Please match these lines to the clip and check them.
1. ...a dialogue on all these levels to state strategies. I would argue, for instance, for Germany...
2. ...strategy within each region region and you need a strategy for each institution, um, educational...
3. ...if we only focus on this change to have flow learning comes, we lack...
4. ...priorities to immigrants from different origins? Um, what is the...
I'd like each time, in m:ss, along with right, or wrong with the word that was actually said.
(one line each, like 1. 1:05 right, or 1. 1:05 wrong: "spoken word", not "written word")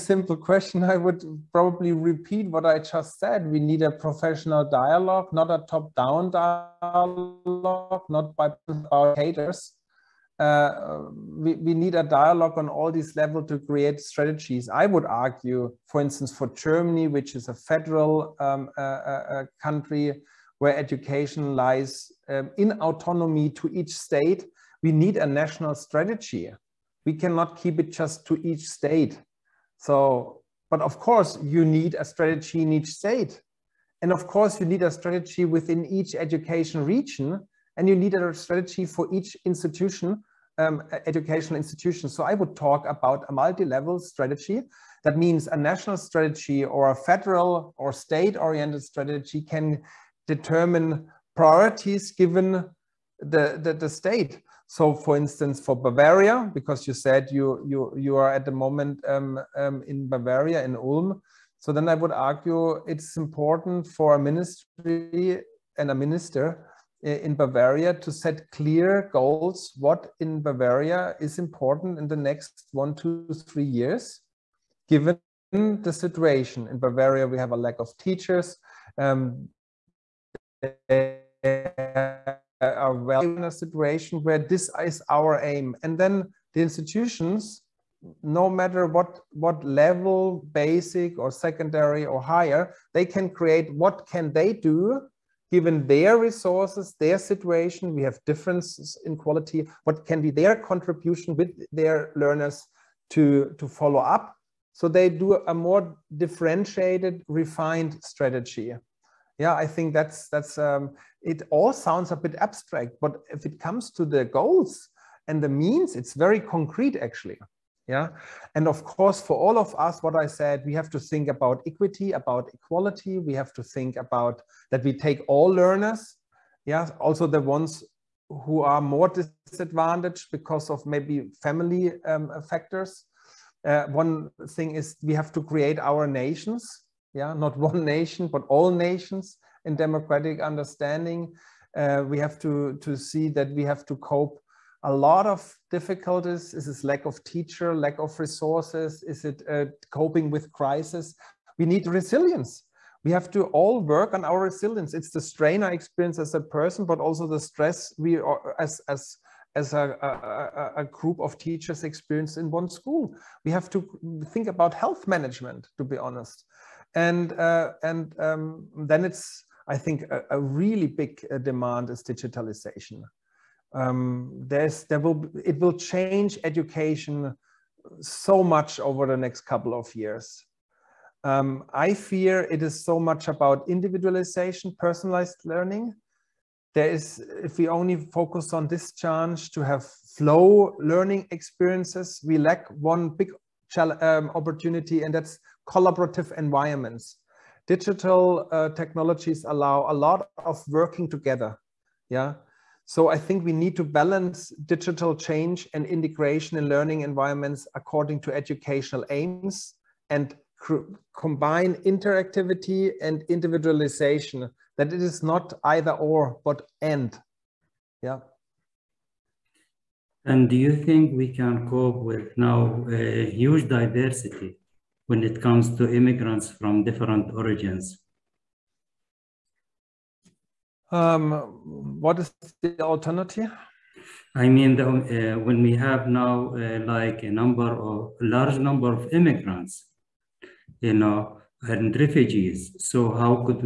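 1. 0:11 wrong: "create", not "state"
2. 0:34 wrong: "education", not "region"
3. 3:07 wrong: "experiences", not "comes"
4. 3:45 wrong: "comes", not "priorities".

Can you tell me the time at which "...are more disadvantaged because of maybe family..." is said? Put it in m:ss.
2:08.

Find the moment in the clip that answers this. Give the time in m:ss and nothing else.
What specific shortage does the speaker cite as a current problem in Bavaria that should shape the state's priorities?
1:17.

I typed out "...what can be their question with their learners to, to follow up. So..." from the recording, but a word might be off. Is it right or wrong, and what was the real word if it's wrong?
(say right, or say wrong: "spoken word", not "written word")
wrong: "contribution", not "question".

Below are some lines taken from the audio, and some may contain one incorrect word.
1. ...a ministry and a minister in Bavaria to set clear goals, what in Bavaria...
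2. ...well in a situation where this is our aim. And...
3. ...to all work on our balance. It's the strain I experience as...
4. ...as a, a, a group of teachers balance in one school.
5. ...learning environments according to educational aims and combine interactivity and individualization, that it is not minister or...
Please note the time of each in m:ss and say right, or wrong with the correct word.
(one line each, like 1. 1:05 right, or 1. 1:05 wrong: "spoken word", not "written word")
1. 1:04 right
2. 1:22 right
3. 2:33 wrong: "resilience", not "balance"
4. 2:39 wrong: "experience", not "balance"
5. 3:26 wrong: "either", not "minister".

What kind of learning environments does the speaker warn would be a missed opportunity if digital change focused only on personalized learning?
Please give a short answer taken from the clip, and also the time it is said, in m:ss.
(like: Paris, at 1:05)
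collaborative environments, at 3:15.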